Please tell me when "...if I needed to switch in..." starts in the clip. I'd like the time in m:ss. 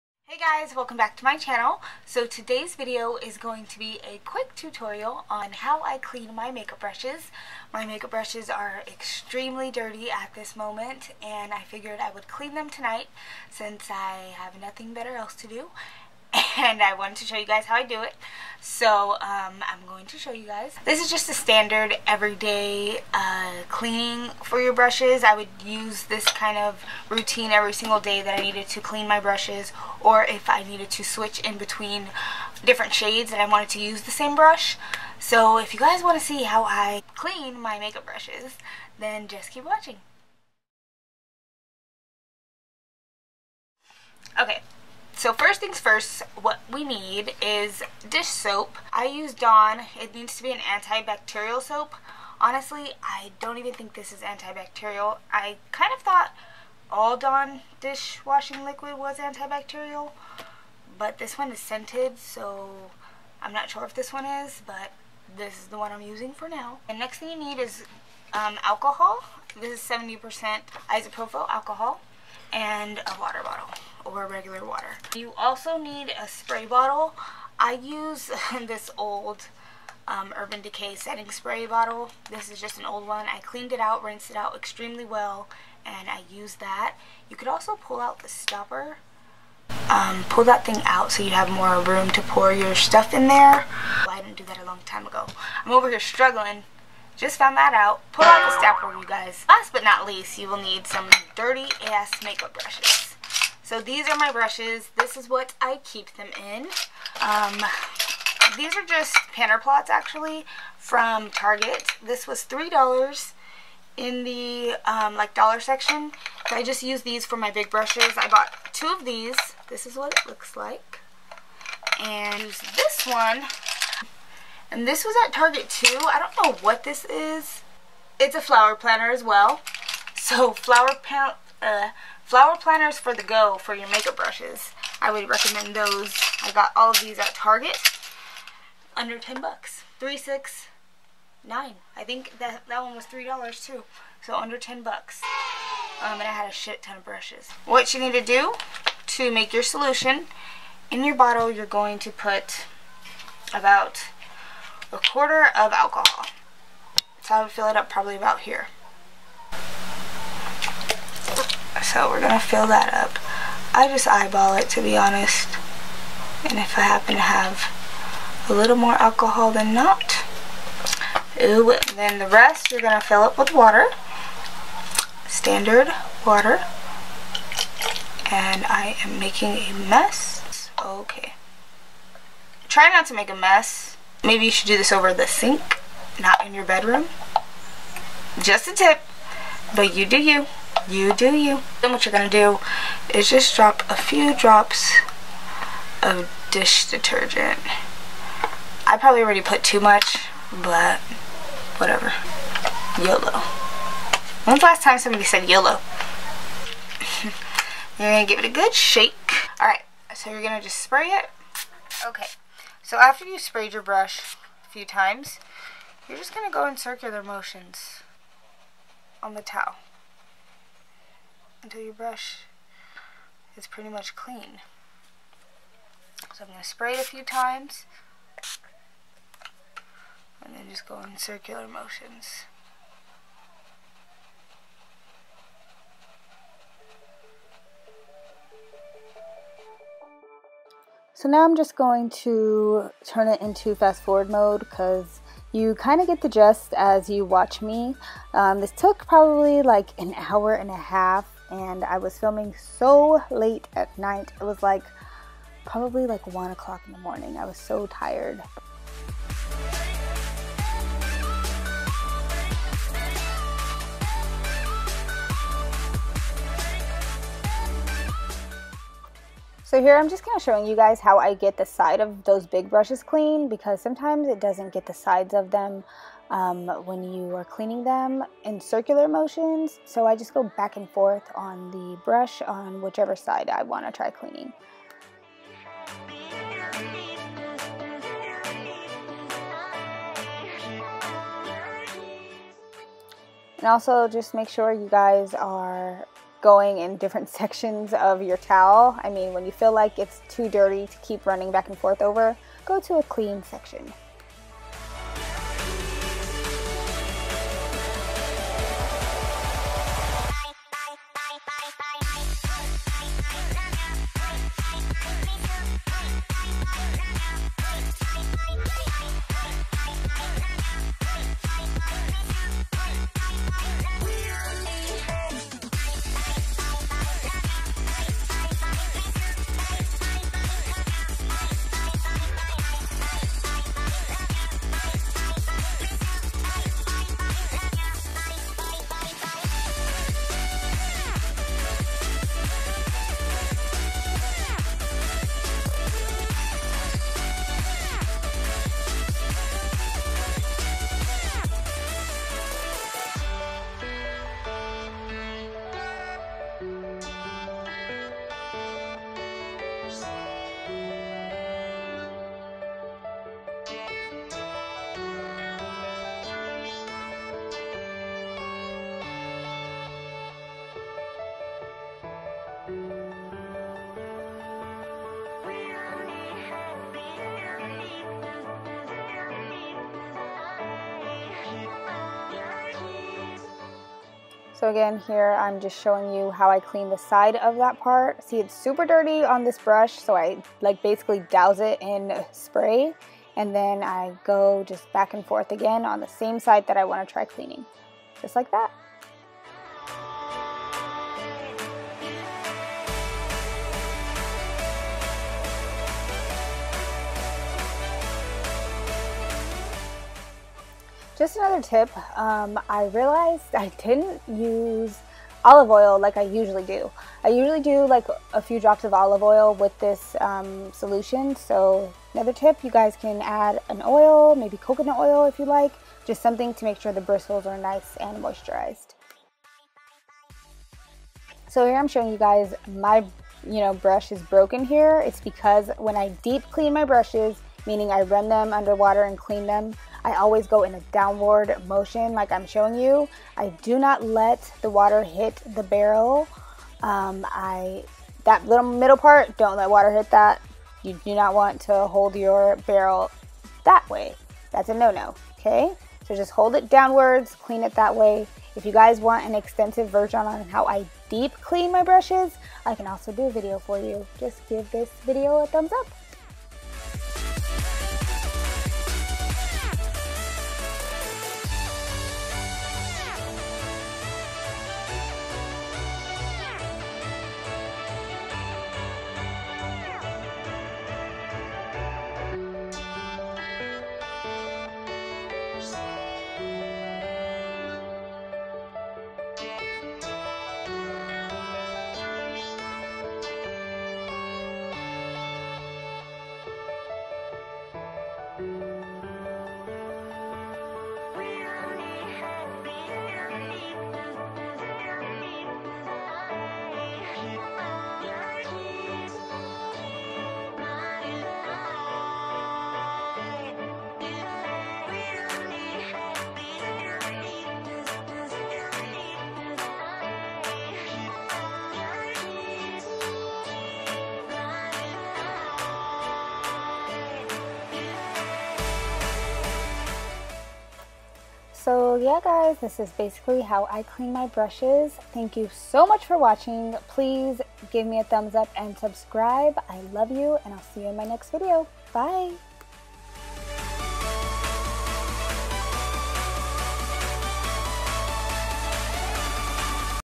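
0:30.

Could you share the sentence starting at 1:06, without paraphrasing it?
The next thing you need is um, alcohol.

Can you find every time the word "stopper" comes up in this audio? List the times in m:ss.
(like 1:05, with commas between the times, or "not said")
1:28, 1:38.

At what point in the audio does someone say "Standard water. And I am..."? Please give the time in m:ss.
2:55.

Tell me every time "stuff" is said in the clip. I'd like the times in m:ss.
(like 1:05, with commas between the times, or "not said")
1:32.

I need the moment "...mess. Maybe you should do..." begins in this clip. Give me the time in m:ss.
3:03.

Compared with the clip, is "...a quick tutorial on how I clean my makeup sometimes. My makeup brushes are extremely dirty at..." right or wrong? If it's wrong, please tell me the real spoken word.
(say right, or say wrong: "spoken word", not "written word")
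wrong: "brushes", not "sometimes".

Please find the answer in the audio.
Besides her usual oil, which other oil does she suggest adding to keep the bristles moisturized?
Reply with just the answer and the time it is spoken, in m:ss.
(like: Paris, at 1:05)
coconut oil, at 7:04.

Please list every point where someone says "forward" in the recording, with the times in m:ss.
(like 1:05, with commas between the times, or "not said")
4:04.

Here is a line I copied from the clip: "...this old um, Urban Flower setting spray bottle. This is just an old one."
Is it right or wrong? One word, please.
wrong.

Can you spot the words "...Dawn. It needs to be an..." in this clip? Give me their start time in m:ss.
0:49.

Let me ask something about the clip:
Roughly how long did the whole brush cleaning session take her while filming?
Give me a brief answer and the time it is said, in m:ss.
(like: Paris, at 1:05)
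an hour and a half, at 4:09.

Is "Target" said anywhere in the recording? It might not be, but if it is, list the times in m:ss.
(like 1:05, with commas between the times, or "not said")
1:51, 2:05, 2:17.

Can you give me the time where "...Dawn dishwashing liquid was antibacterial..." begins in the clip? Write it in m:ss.
0:57.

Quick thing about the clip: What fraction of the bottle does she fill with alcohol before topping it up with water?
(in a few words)
a quarter.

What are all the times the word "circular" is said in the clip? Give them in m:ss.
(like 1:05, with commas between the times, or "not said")
3:36, 3:51, 4:38.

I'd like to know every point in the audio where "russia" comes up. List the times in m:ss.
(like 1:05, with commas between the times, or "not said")
not said.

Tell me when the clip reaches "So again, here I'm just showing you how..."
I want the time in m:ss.
6:24.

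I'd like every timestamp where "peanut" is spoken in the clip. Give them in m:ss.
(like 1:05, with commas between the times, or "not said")
not said.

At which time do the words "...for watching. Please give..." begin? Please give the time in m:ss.
8:56.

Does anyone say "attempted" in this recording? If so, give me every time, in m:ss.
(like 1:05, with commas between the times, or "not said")
not said.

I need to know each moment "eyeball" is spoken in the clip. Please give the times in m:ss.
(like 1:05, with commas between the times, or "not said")
2:44.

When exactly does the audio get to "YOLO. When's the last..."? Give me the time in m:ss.
3:22.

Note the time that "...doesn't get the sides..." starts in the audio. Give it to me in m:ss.
4:34.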